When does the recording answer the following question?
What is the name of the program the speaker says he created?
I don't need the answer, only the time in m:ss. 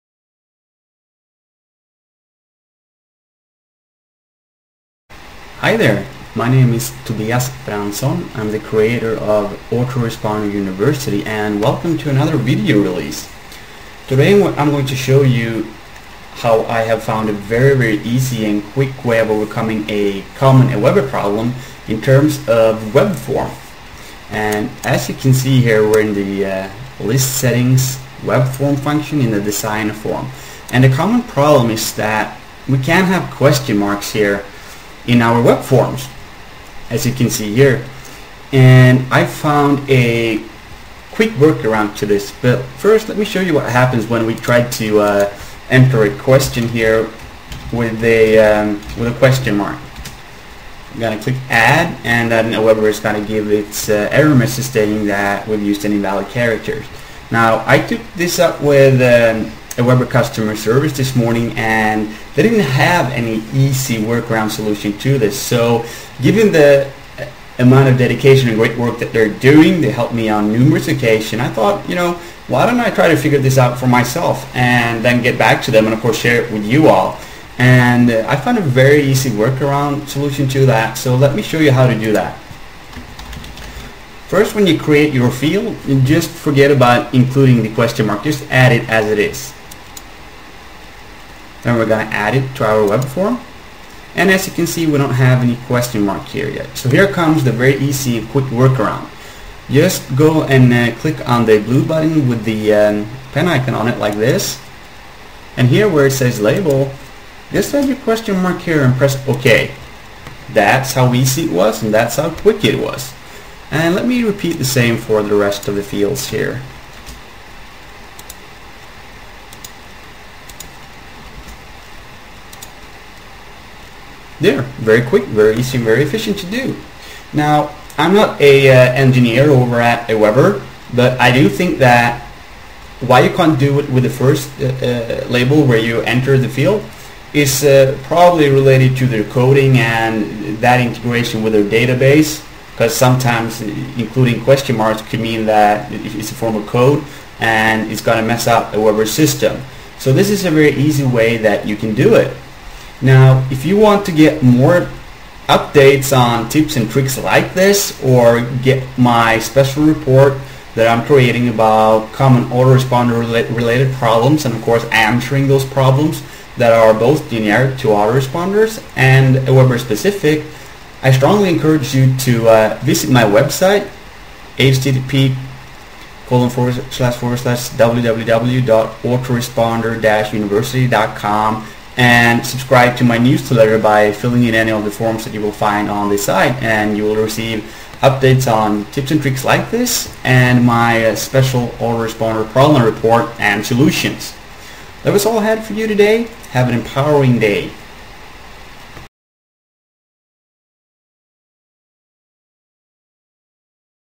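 0:09.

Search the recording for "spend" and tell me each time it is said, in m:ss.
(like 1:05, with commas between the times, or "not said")
not said.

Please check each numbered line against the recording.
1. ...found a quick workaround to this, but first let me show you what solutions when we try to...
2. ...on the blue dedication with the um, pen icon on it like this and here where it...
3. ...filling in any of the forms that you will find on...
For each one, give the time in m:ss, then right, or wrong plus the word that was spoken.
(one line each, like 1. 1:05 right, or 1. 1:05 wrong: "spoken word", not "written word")
1. 0:39 wrong: "happens", not "solutions"
2. 1:41 wrong: "button", not "dedication"
3. 3:04 right.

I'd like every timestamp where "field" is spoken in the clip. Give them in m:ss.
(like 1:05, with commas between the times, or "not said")
1:25, 1:55, 2:16.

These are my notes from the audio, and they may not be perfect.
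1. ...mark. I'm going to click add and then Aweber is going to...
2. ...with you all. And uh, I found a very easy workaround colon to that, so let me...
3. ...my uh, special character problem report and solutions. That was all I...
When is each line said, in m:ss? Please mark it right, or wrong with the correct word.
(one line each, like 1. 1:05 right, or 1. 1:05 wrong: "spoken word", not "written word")
1. 0:49 right
2. 1:16 wrong: "solution", not "colon"
3. 3:10 wrong: "autoresponder", not "character".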